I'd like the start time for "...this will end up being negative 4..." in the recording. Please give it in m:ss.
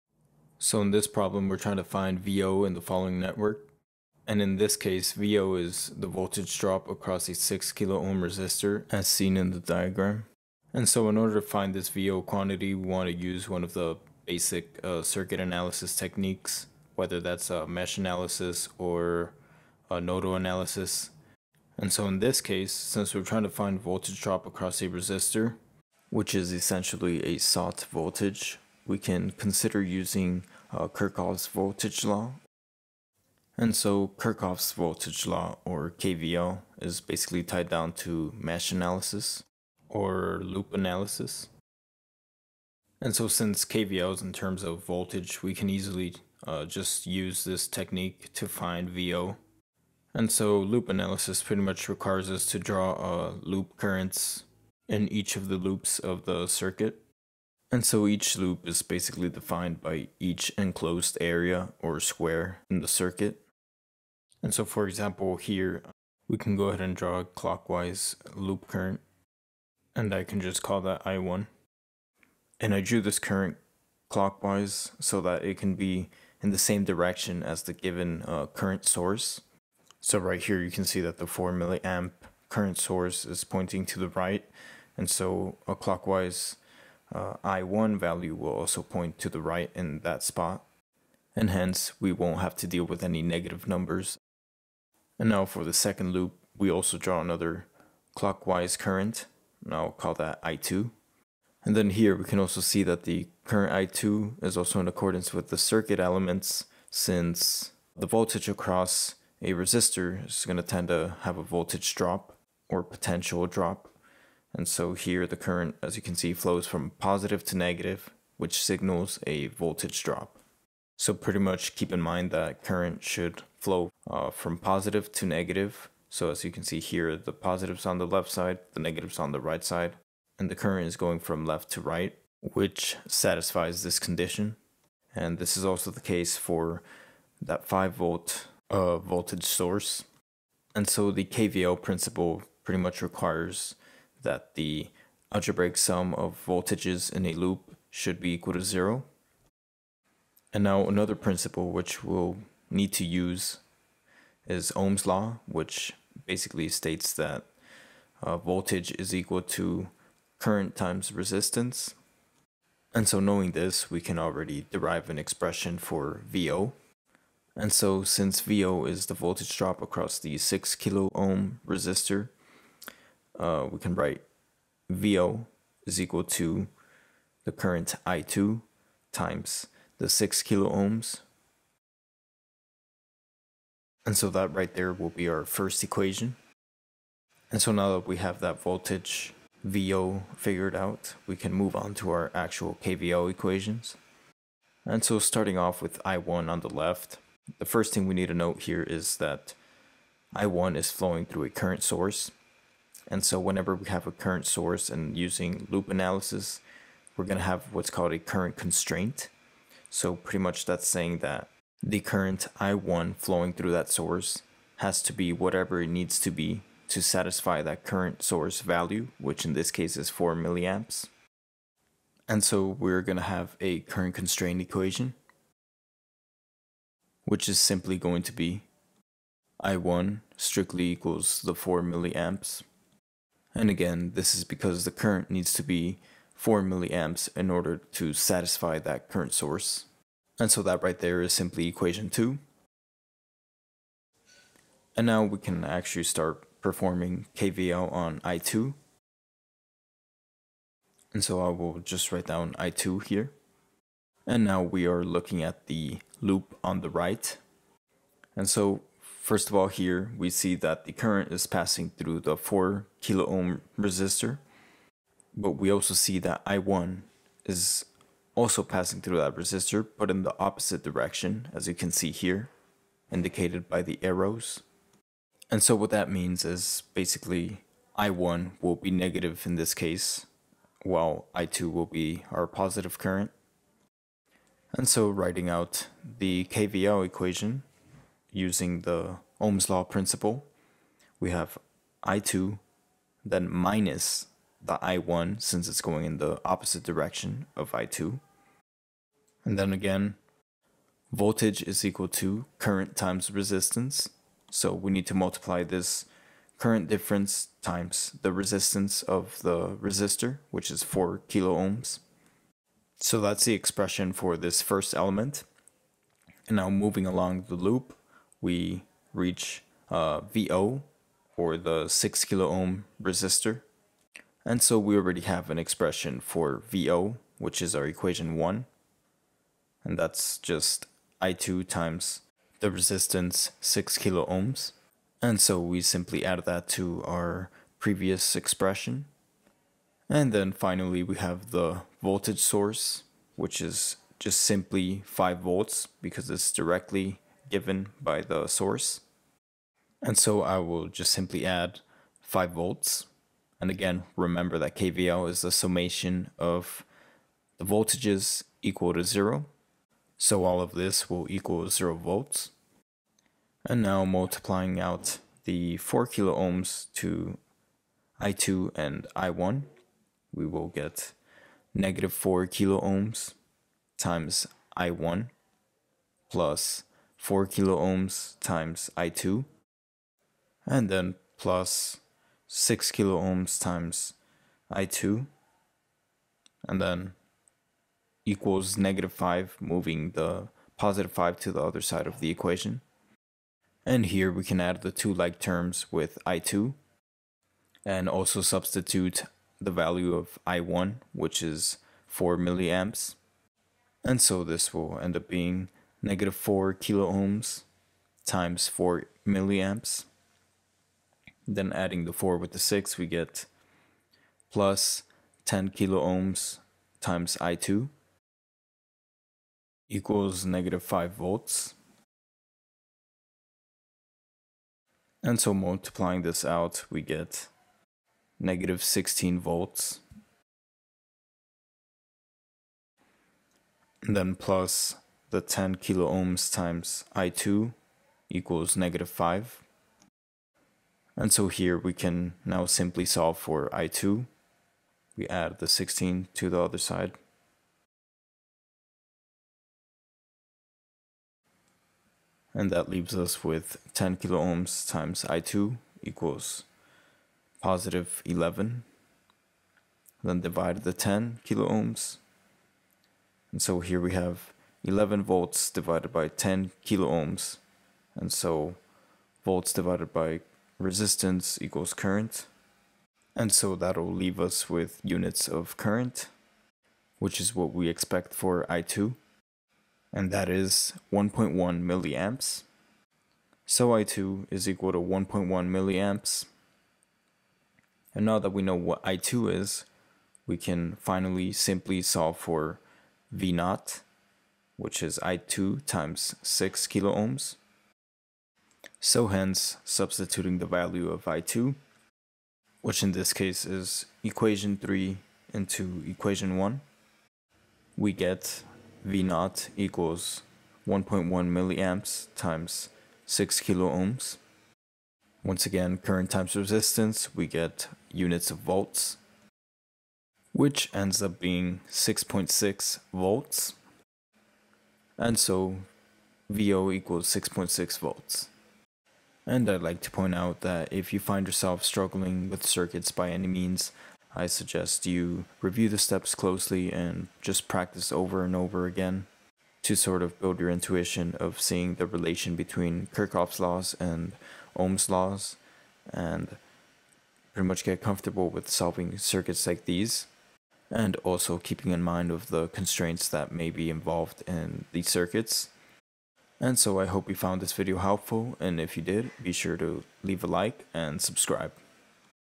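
6:44.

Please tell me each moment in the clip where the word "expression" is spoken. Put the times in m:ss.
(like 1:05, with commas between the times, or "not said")
2:45, 5:13, 5:25, 5:38.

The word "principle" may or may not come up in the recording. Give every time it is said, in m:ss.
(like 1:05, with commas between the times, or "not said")
2:21, 2:31, 4:49.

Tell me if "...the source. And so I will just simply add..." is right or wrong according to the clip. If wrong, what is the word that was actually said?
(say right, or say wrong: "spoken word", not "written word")
right.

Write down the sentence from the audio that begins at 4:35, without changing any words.
And so what that means is basically I1 will be negative in this case, while I2 will be our positive current.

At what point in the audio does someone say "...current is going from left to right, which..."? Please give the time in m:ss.
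2:10.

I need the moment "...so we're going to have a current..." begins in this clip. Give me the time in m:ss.
3:42.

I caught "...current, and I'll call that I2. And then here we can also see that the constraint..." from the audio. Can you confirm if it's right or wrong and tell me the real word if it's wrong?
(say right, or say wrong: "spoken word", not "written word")
wrong: "current", not "constraint".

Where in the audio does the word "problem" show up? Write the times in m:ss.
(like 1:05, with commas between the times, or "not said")
0:01.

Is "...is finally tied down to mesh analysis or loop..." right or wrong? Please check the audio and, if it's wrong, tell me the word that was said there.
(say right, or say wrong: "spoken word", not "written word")
wrong: "basically", not "finally".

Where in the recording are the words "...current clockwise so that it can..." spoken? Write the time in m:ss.
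1:13.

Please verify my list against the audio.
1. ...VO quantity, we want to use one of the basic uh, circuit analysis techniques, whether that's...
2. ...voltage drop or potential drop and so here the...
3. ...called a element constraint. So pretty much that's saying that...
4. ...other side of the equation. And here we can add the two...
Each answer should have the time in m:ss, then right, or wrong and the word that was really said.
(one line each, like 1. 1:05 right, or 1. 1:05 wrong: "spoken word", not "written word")
1. 0:11 right
2. 1:51 right
3. 3:27 wrong: "current", not "element"
4. 6:31 right.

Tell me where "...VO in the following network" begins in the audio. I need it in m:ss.
0:02.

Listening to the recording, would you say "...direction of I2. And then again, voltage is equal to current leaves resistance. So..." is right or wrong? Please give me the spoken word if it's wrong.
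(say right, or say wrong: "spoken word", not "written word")
wrong: "times", not "leaves".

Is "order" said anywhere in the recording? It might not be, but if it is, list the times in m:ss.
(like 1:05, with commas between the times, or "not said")
0:11, 3:57.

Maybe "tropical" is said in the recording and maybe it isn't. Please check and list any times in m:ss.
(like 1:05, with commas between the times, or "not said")
not said.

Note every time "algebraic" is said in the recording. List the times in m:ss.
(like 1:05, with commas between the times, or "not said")
2:25.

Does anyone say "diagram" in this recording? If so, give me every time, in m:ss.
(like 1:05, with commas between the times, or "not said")
0:09.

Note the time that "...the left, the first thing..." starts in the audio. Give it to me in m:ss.
3:16.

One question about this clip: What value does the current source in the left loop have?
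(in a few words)
4 milliamps.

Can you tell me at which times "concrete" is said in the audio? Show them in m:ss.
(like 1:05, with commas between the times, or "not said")
not said.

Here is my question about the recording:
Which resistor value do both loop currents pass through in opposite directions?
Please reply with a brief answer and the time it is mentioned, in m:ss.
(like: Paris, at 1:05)
4 kilo ohms, at 4:22.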